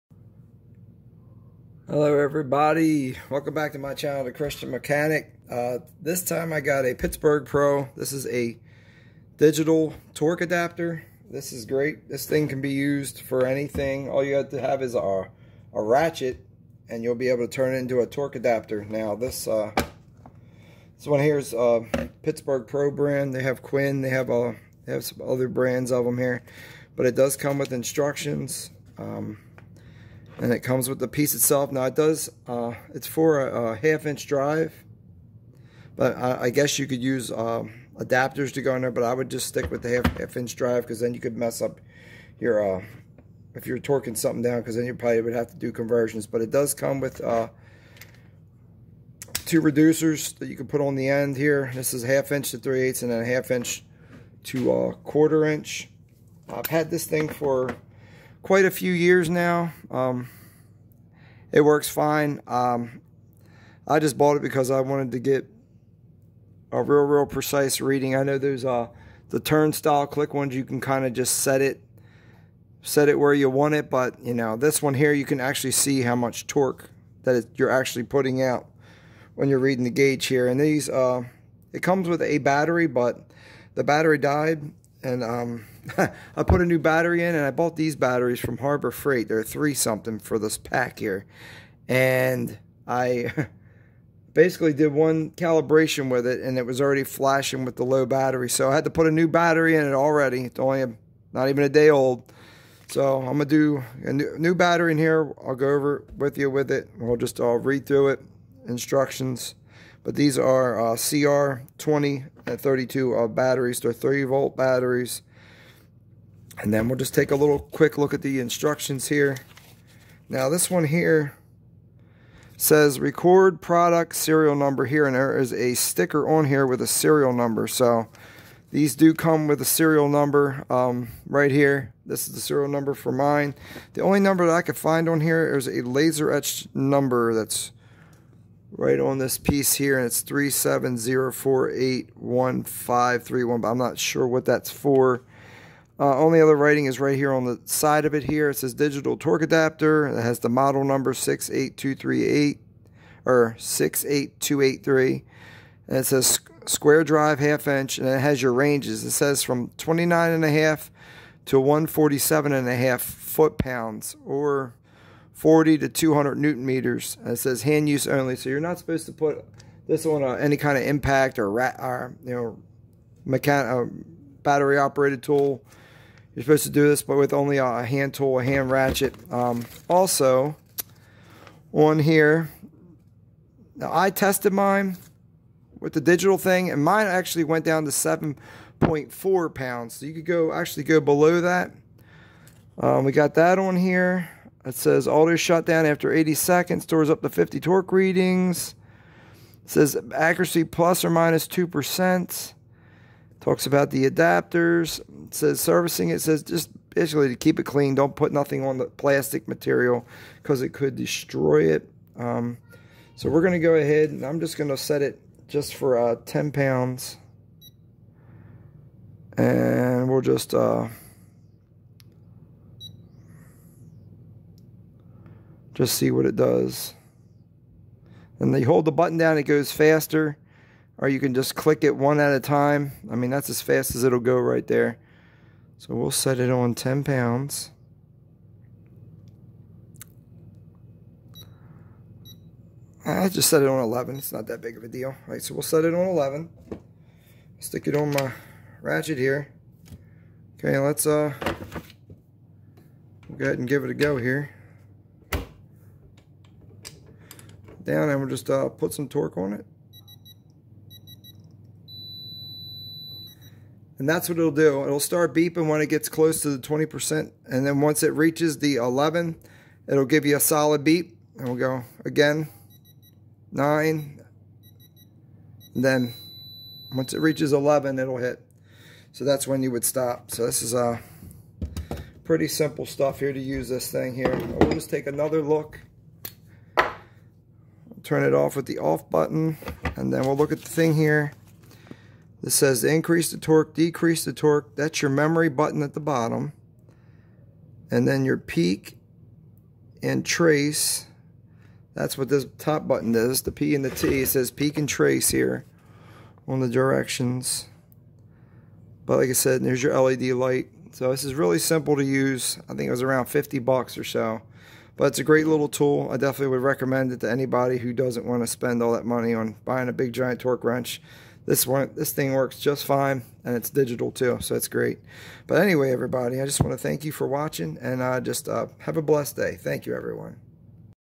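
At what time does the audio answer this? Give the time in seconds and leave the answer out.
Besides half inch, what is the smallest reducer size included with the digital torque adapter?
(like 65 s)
54 s.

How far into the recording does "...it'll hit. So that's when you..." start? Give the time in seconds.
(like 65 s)
277 s.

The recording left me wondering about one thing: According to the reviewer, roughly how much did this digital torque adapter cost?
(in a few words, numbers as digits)
around 50 bucks.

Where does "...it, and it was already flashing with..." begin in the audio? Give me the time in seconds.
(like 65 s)
96 s.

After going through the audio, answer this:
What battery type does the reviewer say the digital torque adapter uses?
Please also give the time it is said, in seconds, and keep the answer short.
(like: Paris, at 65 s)
CR2032, at 110 s.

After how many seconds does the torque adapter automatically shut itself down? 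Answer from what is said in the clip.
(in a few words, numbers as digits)
80 seconds.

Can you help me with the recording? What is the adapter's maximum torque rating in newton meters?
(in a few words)
200 newton meters.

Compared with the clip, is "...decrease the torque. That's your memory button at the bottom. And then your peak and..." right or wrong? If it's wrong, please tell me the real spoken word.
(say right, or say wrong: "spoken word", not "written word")
right.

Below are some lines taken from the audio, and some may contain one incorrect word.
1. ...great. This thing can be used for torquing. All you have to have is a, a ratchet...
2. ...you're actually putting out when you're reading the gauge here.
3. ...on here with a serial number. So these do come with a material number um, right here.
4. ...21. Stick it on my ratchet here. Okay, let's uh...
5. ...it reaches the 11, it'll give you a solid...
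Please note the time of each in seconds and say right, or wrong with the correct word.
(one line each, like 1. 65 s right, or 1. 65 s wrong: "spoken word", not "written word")
1. 11 s wrong: "anything", not "torquing"
2. 77 s right
3. 126 s wrong: "serial", not "material"
4. 246 s wrong: "11", not "21"
5. 268 s right.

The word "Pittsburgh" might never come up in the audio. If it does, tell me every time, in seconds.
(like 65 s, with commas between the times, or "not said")
6 s, 22 s.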